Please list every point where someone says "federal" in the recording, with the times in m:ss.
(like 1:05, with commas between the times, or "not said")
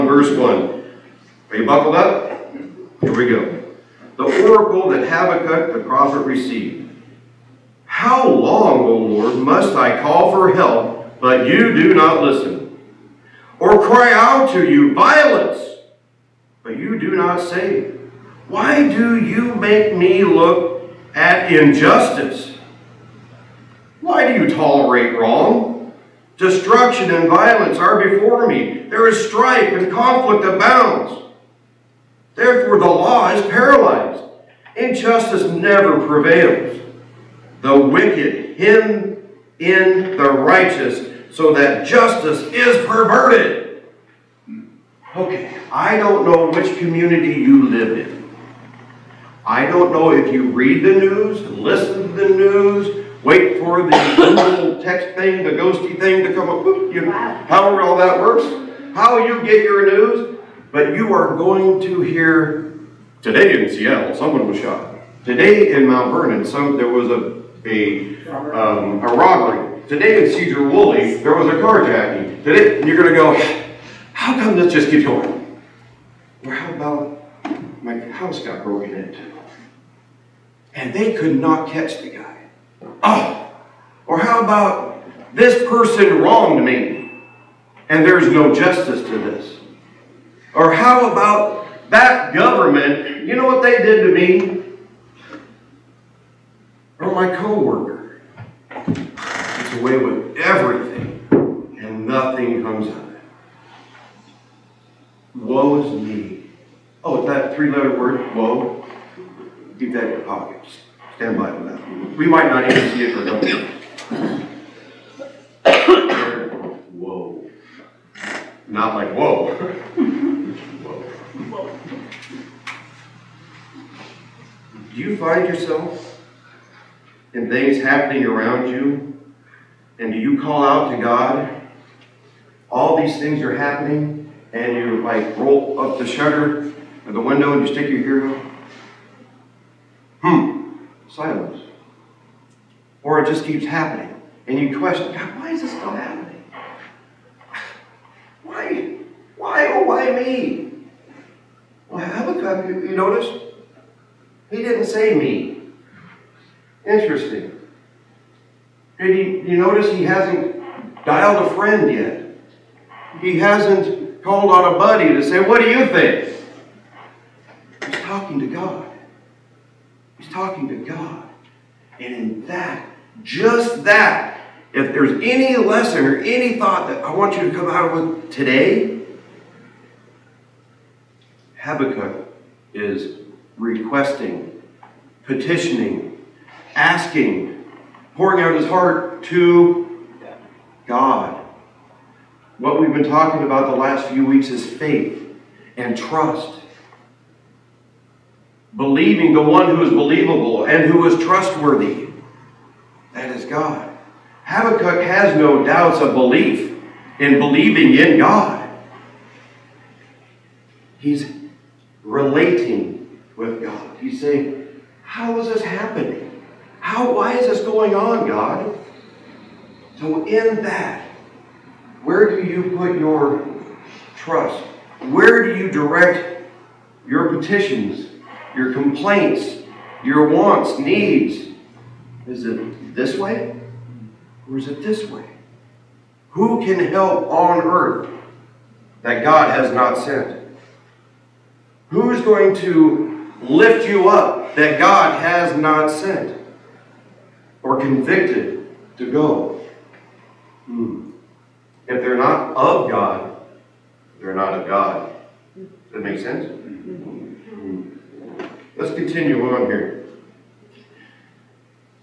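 not said.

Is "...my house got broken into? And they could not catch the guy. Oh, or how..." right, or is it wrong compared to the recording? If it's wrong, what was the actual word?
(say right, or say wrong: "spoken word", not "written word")
right.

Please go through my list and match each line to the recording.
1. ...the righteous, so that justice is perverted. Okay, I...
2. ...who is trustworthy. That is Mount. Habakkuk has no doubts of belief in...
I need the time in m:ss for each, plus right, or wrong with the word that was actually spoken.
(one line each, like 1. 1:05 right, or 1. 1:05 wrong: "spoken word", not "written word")
1. 0:40 right
2. 3:20 wrong: "God", not "Mount".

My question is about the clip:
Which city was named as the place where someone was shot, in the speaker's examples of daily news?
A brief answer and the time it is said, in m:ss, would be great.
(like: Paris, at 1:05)
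Seattle, at 1:03.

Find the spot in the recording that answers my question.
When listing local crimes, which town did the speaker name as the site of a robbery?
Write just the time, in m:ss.
1:05.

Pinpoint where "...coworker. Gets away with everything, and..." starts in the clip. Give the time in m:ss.
1:37.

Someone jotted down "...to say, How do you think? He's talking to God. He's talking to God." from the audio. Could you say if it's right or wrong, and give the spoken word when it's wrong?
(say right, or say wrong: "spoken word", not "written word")
wrong: "What", not "How".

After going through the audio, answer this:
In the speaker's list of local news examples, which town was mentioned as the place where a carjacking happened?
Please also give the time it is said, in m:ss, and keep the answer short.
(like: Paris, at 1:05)
Sedro-Woolley, at 1:10.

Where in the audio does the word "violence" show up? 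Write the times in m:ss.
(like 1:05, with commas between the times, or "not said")
0:14, 0:27.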